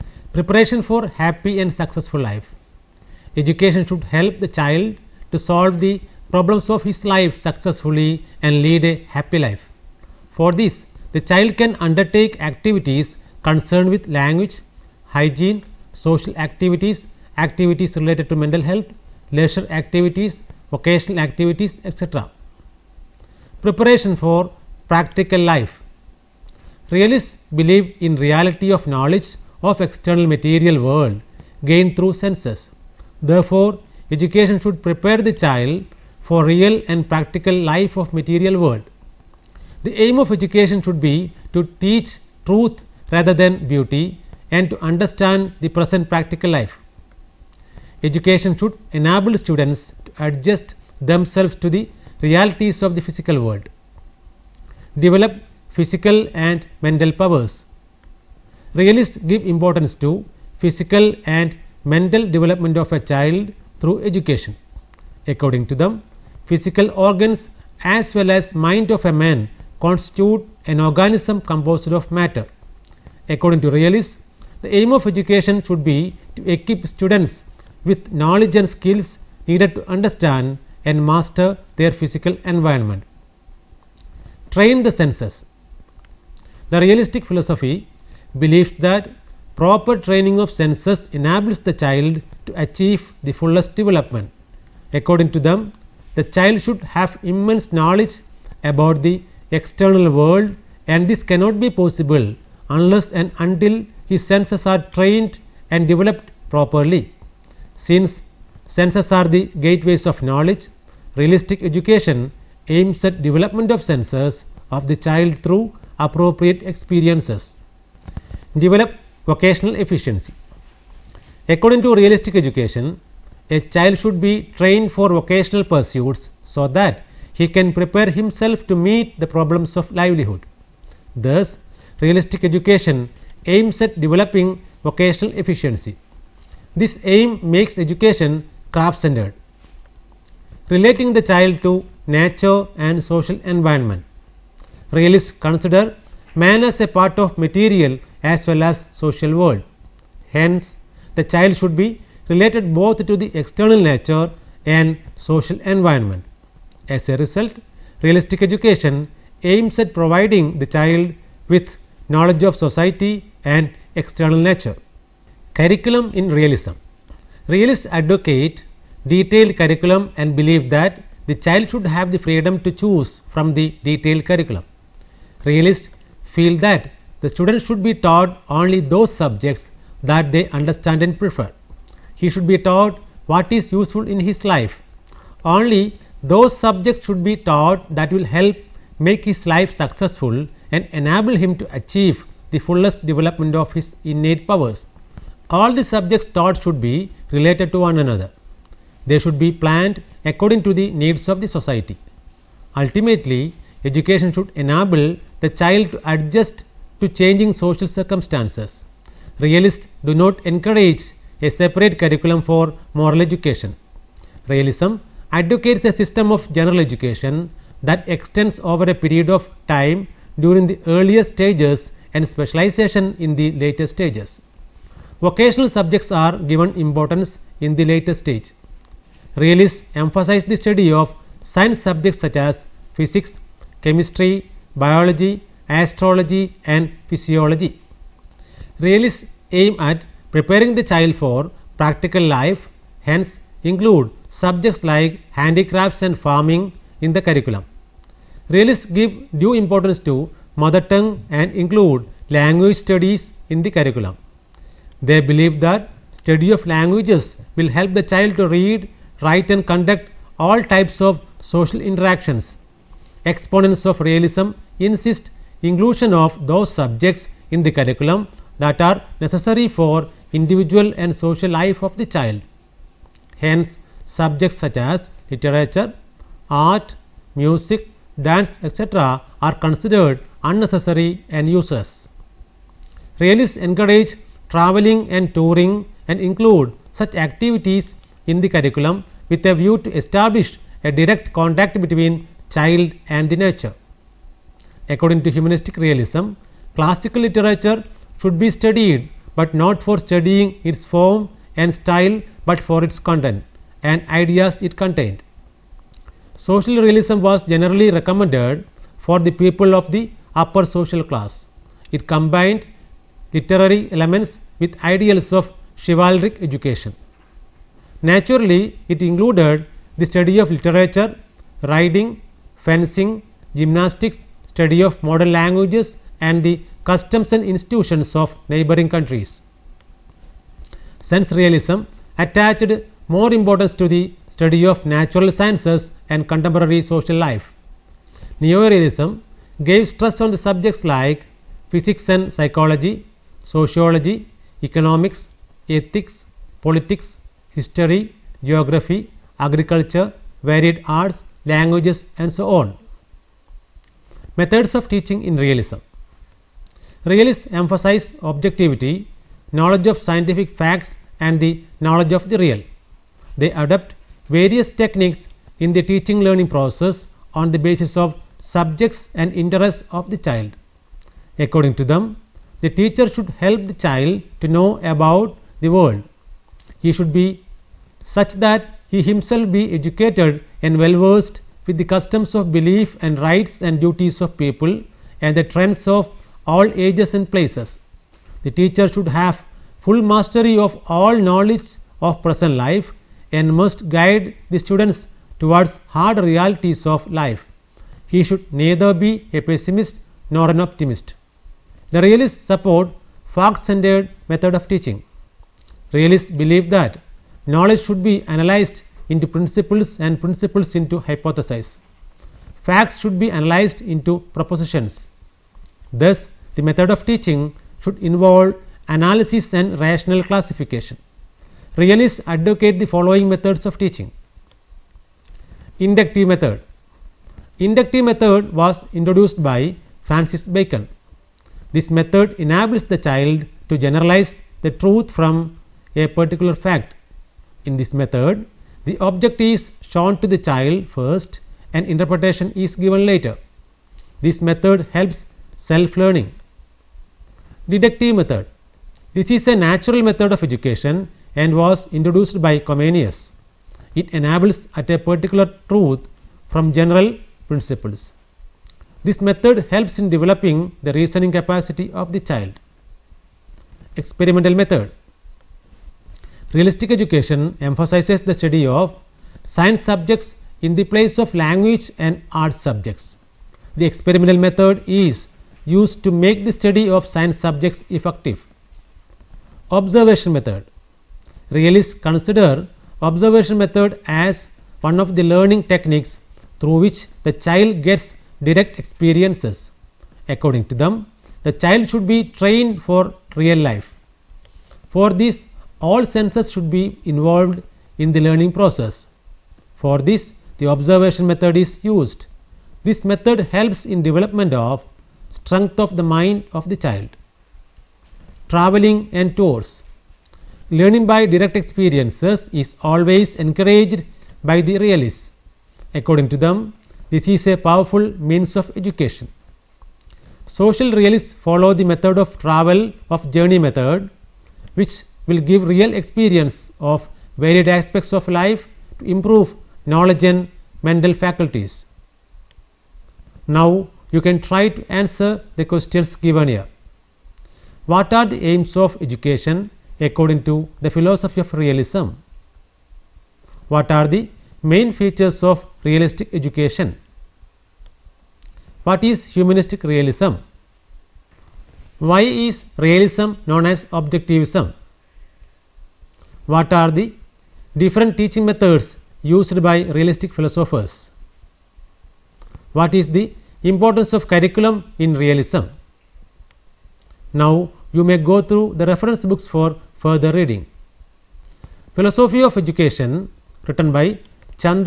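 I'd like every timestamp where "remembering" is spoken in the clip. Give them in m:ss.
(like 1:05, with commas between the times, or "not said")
not said.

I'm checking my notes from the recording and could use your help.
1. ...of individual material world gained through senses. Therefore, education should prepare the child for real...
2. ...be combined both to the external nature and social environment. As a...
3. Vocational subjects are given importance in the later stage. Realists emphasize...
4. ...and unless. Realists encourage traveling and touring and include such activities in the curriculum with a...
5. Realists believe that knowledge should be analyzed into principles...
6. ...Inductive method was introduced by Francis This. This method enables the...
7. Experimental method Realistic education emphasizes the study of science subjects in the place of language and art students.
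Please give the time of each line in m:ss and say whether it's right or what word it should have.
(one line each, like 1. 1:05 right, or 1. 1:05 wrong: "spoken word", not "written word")
1. 0:29 wrong: "external", not "individual"
2. 2:31 wrong: "related", not "combined"
3. 3:45 right
4. 4:41 wrong: "useless", not "unless"
5. 6:45 right
6. 7:07 wrong: "Bacon", not "This"
7. 7:43 wrong: "subjects", not "students".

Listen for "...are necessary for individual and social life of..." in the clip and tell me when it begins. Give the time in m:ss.
4:28.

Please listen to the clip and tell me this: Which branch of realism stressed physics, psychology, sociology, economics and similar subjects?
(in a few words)
Neo-realism.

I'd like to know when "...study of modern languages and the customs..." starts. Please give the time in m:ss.
5:24.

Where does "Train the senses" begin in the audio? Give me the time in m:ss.
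1:24.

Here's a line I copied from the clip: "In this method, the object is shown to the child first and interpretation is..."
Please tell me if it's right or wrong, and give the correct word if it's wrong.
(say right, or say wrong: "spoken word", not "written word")
right.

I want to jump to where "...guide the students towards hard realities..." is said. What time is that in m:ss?
6:33.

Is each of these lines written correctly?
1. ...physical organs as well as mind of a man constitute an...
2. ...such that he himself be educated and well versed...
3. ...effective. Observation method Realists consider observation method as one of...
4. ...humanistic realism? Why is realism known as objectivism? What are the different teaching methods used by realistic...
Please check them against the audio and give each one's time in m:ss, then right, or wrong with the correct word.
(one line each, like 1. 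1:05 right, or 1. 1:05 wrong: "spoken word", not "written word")
1. 1:06 right
2. 6:17 right
3. 7:57 right
4. 9:09 right.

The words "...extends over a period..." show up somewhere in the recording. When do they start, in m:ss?
3:38.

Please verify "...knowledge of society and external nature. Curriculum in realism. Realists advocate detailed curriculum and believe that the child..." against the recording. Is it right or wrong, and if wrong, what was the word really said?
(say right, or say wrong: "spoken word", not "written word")
right.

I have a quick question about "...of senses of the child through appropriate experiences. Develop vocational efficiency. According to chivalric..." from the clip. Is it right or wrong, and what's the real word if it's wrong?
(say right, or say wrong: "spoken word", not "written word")
wrong: "realistic", not "chivalric".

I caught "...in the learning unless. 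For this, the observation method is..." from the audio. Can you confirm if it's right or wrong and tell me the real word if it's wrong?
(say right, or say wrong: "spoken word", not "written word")
wrong: "process", not "unless".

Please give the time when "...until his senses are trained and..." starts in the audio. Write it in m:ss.
1:43.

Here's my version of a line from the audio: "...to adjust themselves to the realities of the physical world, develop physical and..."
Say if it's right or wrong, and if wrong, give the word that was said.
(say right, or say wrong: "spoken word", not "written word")
right.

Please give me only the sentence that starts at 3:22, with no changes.
Ultimately, education should enable the child to adjust to changing social circumstances.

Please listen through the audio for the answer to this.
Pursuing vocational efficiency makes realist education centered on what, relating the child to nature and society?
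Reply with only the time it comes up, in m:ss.
2:18.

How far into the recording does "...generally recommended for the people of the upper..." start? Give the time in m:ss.
5:07.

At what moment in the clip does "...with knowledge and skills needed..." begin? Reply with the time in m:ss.
1:17.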